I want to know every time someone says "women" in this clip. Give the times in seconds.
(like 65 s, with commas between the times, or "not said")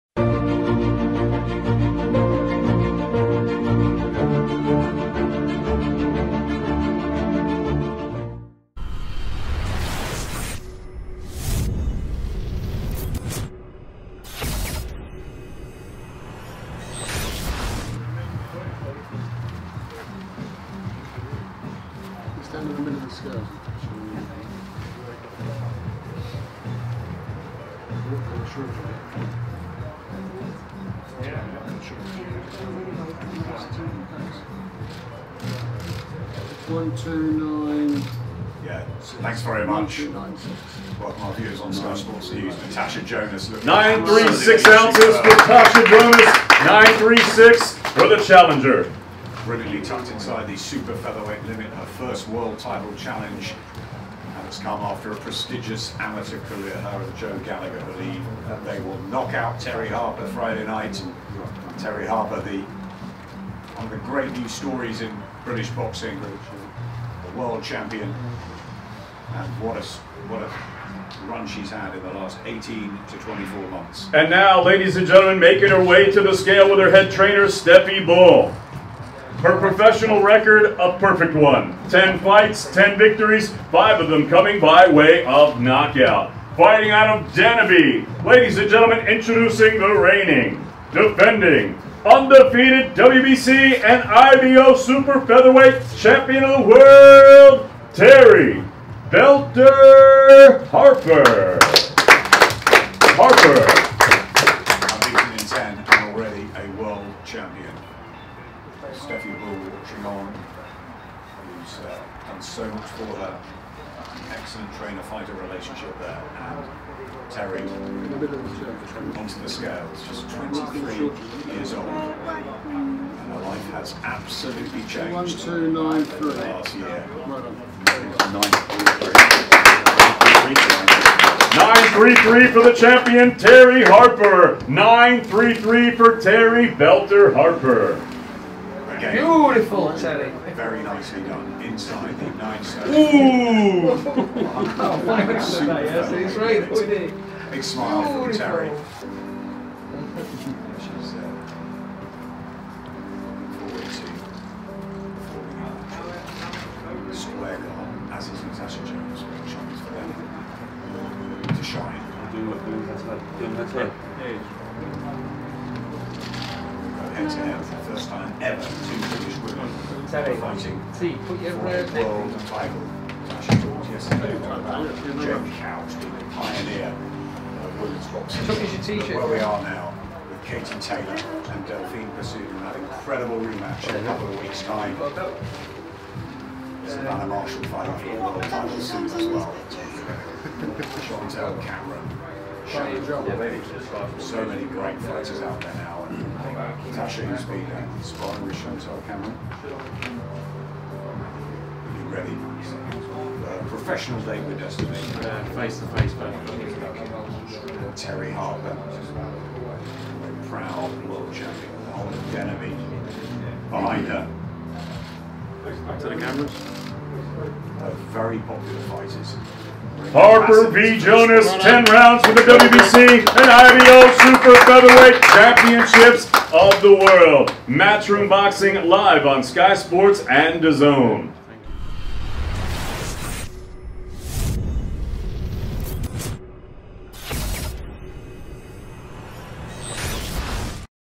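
22 s, 169 s, 177 s.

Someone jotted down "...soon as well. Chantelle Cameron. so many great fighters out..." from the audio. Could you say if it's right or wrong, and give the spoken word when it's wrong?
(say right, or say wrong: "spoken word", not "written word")
right.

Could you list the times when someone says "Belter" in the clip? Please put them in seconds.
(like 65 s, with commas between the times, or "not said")
99 s, 136 s.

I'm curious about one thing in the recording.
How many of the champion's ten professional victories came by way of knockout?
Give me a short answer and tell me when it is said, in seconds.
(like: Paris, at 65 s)
5, at 83 s.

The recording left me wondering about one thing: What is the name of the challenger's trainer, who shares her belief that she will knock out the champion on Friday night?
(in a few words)
Joe Gallagher.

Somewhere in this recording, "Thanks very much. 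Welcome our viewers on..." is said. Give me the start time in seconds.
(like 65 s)
39 s.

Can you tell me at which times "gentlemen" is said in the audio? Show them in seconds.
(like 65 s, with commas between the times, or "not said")
75 s, 88 s.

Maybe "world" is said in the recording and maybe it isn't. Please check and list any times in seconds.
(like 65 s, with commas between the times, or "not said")
52 s, 67 s, 96 s, 106 s, 171 s, 188 s, 211 s, 226 s.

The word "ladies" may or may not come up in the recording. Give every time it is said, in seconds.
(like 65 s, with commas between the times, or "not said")
74 s, 88 s.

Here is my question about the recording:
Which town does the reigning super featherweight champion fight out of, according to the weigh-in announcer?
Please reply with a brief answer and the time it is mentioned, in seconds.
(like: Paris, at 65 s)
Denaby, at 87 s.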